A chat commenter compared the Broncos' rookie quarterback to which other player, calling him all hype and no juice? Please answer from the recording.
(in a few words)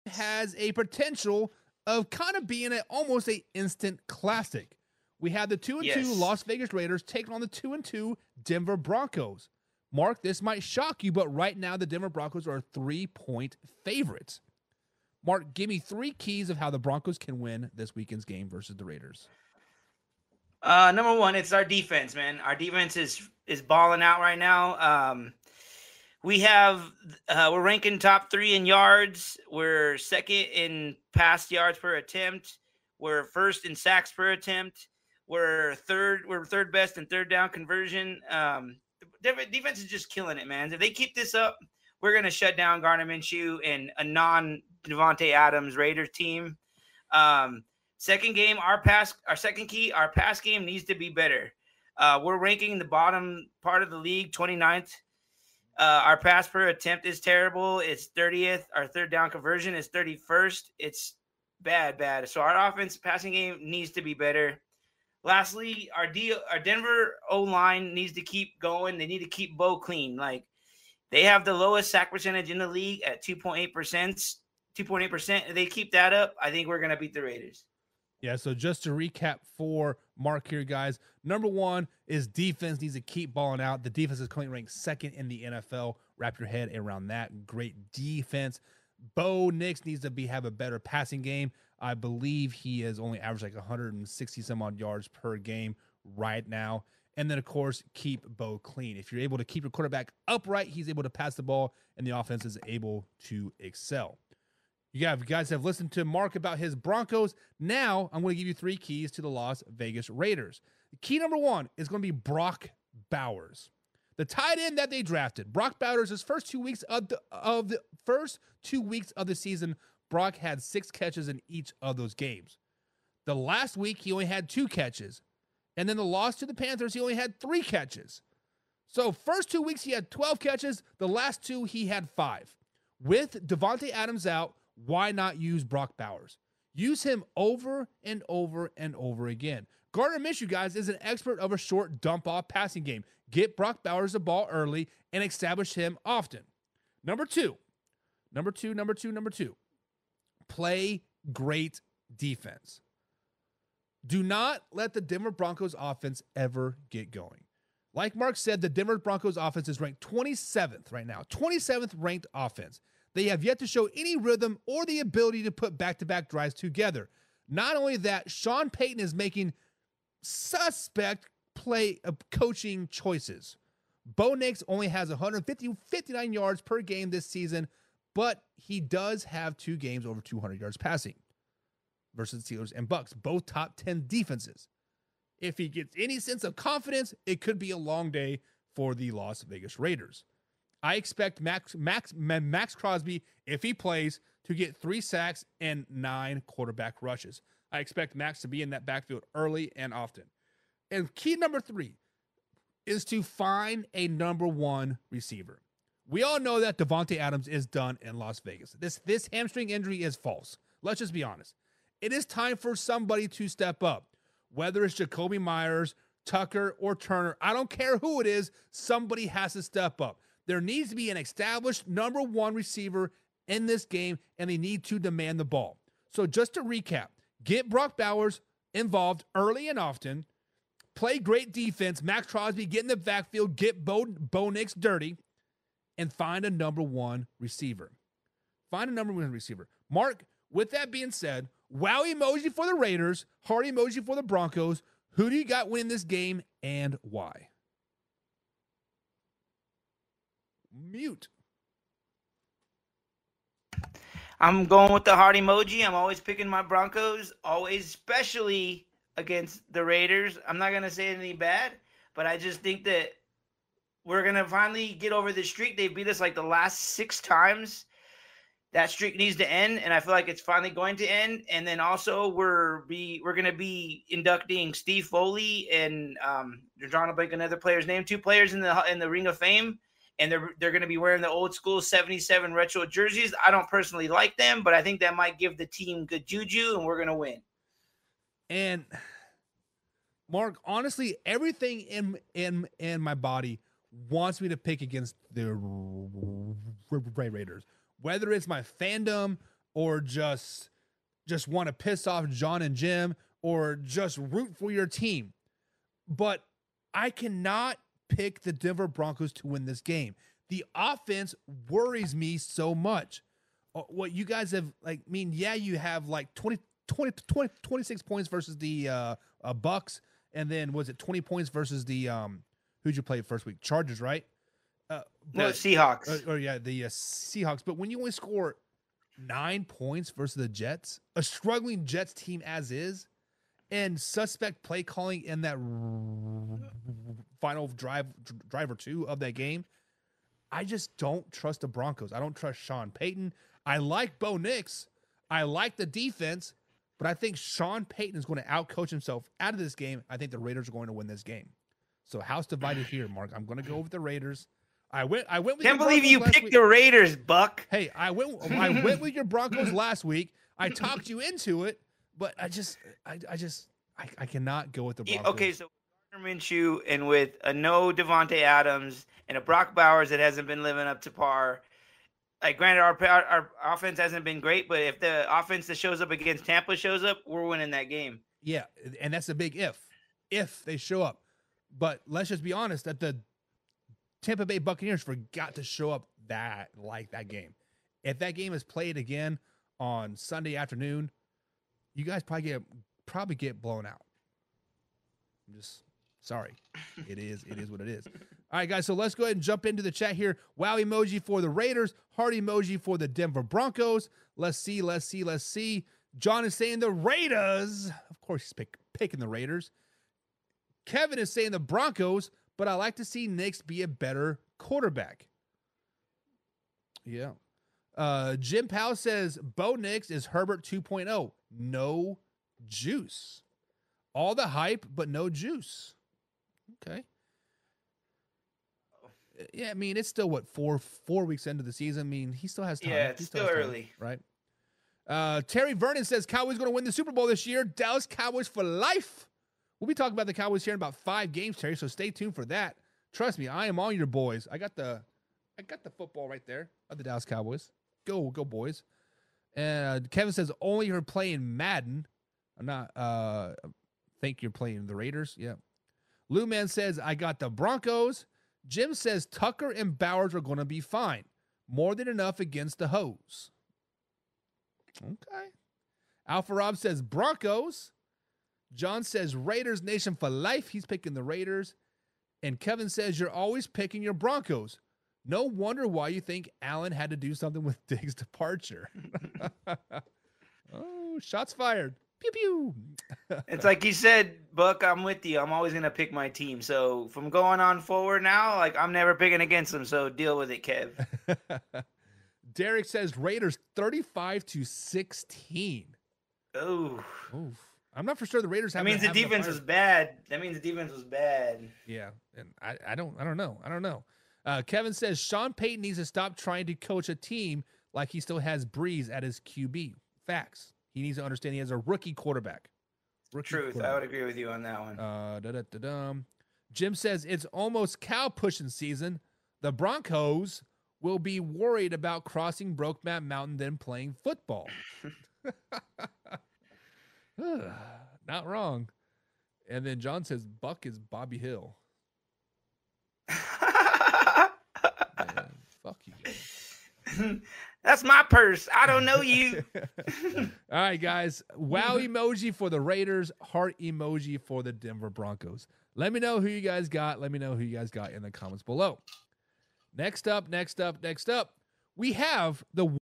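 Herbert.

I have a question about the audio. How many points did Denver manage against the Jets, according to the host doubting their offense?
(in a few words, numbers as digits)
9.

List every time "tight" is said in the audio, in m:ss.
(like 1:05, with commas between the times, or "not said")
1:54.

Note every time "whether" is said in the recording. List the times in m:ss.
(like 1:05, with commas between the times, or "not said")
3:34, 4:57.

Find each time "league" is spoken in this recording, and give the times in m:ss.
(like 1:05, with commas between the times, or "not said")
0:53, 1:12.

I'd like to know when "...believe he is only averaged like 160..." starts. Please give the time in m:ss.
1:31.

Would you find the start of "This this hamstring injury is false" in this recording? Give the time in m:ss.
3:28.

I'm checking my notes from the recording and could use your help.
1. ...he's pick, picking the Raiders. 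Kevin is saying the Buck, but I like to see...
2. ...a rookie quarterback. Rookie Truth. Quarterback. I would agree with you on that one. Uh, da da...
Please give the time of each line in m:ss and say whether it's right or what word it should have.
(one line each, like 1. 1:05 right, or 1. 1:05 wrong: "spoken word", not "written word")
1. 6:48 wrong: "Broncos", not "Buck"
2. 8:31 right.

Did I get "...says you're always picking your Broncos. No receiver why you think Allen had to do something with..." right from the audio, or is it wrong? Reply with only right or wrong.
wrong.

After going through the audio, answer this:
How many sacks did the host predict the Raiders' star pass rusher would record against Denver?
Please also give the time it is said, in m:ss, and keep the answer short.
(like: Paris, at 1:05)
3, at 3:14.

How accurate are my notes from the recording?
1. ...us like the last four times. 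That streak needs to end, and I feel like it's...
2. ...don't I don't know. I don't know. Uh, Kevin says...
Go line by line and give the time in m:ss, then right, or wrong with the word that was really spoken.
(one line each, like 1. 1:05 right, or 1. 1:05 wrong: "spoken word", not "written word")
1. 4:26 wrong: "six", not "four"
2. 8:22 right.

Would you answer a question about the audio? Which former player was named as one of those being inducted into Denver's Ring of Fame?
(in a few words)
Steve Foley.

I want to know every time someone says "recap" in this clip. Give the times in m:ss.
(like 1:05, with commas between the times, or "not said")
1:18, 3:46.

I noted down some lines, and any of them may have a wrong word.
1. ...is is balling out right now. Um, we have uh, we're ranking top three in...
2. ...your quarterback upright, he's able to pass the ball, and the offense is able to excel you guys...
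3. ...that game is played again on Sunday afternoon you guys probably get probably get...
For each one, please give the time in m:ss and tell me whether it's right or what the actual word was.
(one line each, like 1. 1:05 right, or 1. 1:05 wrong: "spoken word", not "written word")
1. 0:22 right
2. 1:39 right
3. 6:28 right.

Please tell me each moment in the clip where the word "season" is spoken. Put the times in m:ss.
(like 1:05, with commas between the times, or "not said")
1:59, 2:57, 7:11, 8:38.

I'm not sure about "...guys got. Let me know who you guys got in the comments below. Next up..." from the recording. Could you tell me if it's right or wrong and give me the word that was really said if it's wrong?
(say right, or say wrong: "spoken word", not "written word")
right.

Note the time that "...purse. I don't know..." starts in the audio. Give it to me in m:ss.
8:58.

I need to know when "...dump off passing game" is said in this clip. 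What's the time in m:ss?
2:21.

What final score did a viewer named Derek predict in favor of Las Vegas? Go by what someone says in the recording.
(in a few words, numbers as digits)
35 to 16.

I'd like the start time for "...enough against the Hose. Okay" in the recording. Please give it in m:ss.
7:42.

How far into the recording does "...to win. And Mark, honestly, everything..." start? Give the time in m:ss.
4:47.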